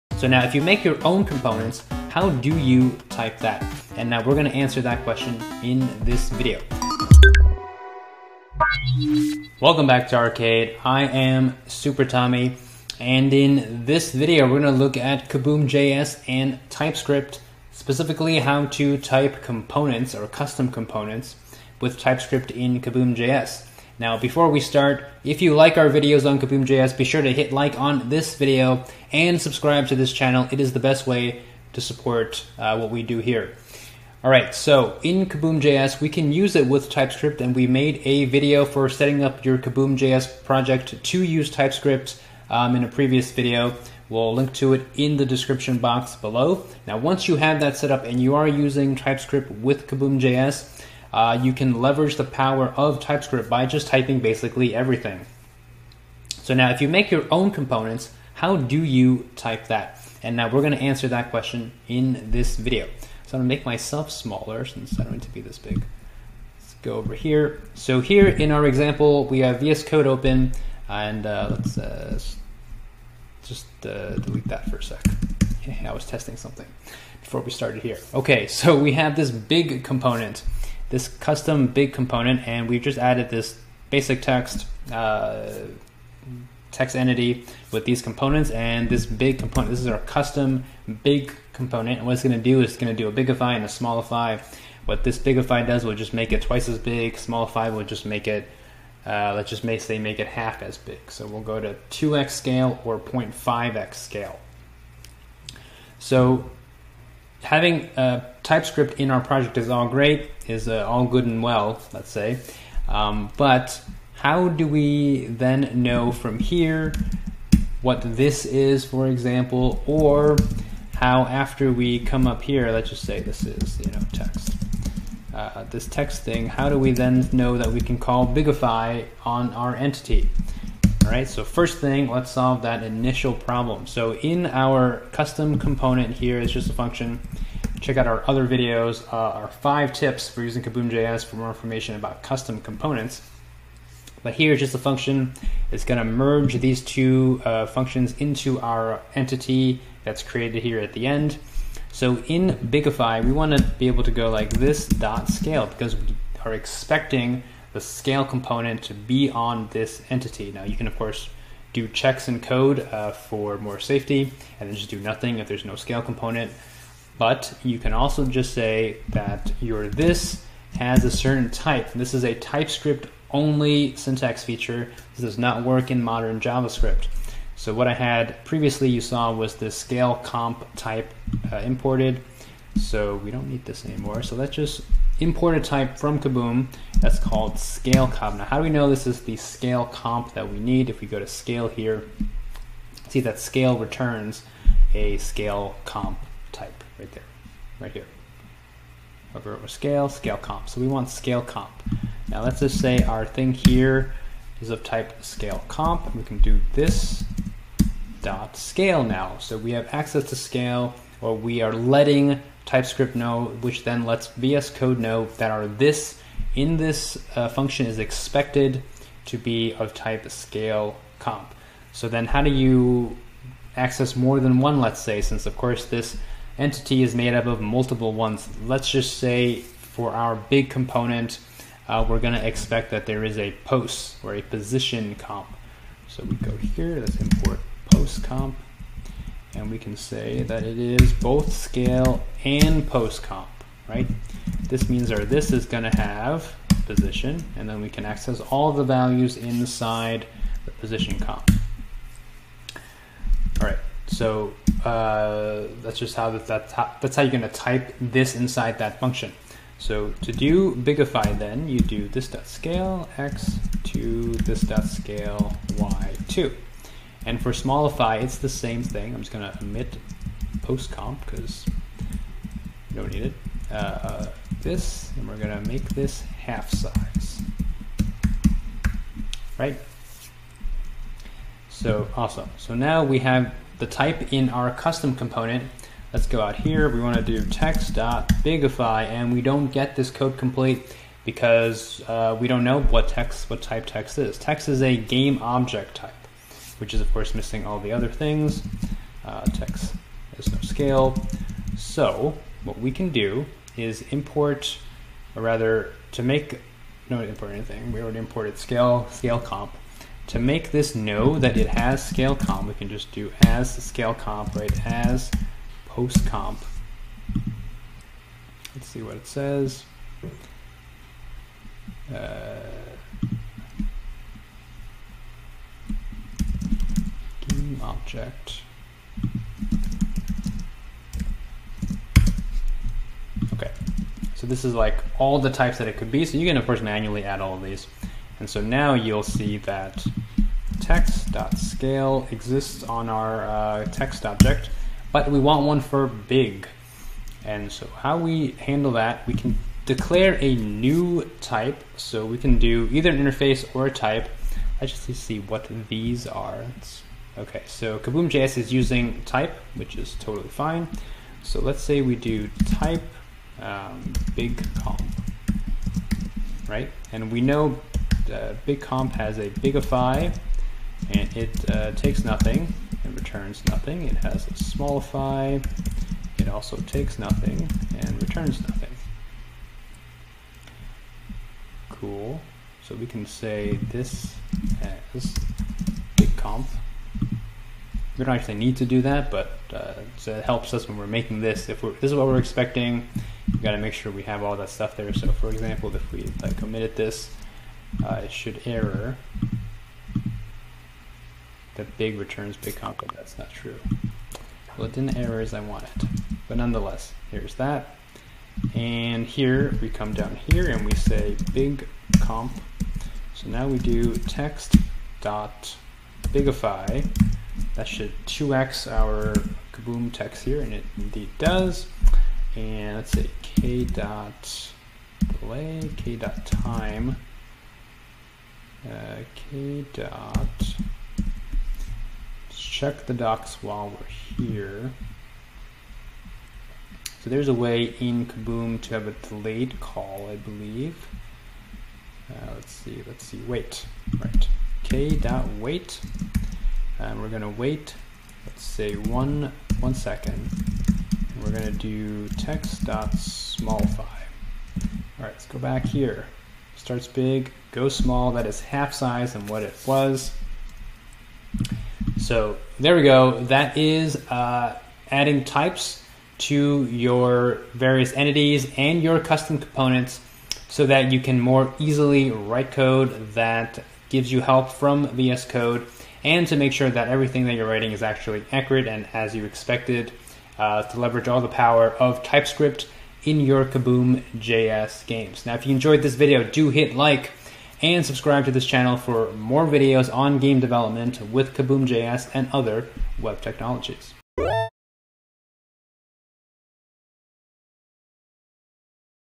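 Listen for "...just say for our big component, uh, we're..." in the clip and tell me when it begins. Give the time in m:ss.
3:48.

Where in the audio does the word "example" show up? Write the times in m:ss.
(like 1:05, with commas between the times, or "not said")
1:08, 1:59, 6:35.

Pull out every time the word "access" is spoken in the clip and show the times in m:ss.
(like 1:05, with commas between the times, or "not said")
3:29, 3:43, 4:08.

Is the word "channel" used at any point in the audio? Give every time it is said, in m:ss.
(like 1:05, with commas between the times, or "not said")
0:30, 8:08.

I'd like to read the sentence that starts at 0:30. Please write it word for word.
It is the best way to support uh, what we do here.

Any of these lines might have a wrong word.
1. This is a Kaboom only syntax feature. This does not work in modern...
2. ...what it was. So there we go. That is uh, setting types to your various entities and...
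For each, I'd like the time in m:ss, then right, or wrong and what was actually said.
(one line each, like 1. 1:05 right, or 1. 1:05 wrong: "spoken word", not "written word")
1. 2:51 wrong: "TypeScript", not "Kaboom"
2. 7:39 wrong: "adding", not "setting".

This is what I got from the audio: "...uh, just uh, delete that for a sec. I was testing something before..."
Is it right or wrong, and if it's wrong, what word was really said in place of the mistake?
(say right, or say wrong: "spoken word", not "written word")
right.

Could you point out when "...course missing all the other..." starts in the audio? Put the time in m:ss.
4:57.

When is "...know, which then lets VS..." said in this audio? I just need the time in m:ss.
3:33.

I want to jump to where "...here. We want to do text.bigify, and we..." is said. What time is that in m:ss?
4:46.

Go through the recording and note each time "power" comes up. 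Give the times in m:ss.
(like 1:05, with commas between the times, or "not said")
0:52, 8:01.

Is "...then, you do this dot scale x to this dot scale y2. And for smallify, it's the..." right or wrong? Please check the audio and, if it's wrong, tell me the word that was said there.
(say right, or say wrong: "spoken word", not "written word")
right.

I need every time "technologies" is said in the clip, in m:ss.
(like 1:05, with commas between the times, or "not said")
8:13.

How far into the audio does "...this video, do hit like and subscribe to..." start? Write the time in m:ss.
8:06.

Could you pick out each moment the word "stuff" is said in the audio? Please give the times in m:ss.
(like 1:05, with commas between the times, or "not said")
6:34.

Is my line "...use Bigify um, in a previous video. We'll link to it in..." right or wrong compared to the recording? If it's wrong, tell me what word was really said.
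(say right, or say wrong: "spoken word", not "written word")
wrong: "TypeScript", not "Bigify".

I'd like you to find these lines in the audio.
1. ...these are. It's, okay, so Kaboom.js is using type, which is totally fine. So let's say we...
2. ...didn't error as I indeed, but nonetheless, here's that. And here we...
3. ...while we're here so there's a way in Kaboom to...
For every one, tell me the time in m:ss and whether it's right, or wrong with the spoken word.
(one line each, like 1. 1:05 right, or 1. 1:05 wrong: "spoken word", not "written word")
1. 5:55 right
2. 6:44 wrong: "wanted", not "indeed"
3. 7:13 right.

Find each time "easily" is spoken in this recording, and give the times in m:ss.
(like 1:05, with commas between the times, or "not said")
7:51.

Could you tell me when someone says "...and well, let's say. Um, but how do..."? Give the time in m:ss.
1:51.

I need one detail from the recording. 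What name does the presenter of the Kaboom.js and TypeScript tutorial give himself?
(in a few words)
Super Tommy.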